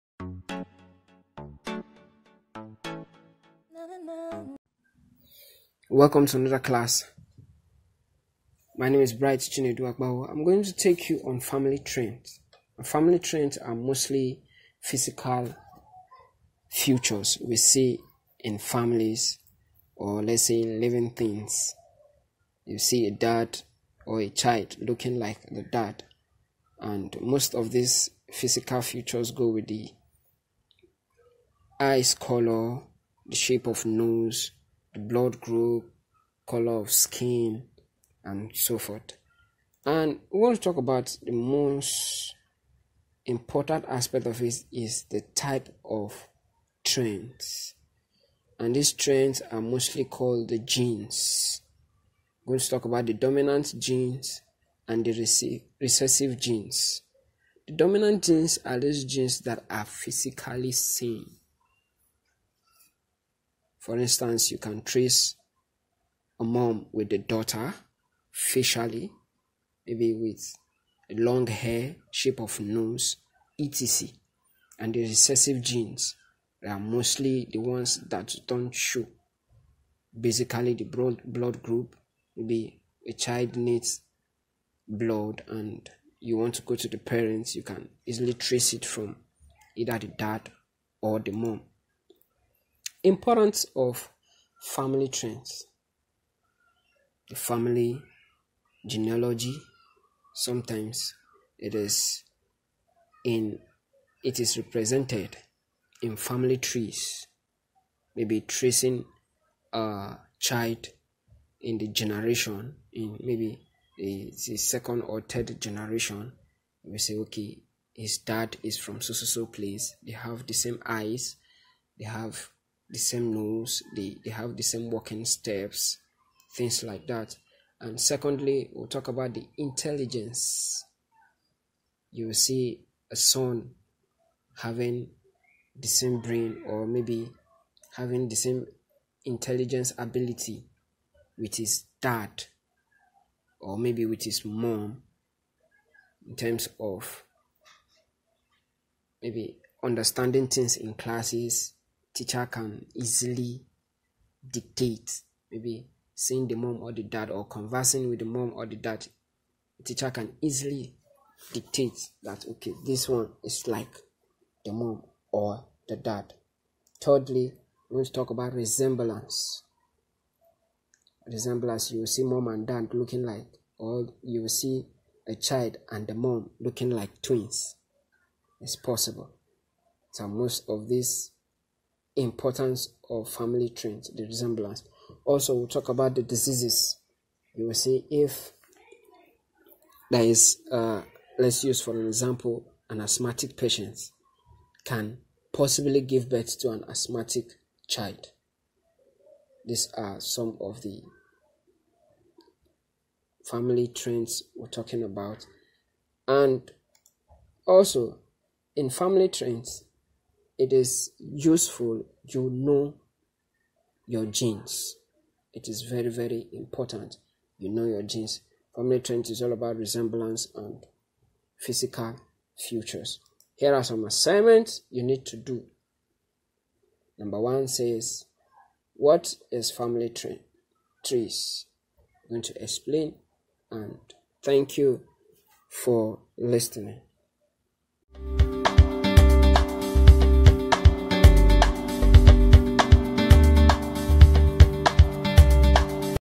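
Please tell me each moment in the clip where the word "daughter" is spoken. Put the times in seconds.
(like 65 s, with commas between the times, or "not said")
67 s.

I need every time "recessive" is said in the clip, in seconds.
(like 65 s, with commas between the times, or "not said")
55 s, 75 s.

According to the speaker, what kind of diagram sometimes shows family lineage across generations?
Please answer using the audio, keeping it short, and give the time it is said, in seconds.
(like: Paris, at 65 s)
family trees, at 106 s.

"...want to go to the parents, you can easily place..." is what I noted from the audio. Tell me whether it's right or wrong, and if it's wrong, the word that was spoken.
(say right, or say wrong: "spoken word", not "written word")
wrong: "trace", not "place".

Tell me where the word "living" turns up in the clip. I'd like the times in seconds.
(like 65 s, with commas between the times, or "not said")
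20 s.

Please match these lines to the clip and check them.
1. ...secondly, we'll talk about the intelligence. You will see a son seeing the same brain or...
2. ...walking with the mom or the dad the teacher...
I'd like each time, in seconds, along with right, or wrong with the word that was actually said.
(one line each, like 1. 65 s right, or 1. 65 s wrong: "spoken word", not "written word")
1. 127 s wrong: "having", not "seeing"
2. 157 s wrong: "conversing", not "walking".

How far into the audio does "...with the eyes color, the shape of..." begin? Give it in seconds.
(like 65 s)
29 s.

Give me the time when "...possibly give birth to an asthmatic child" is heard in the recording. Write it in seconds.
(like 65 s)
195 s.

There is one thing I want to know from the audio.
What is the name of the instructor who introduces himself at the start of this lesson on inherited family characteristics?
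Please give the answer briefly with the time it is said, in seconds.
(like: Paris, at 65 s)
Bright Chinedu, at 9 s.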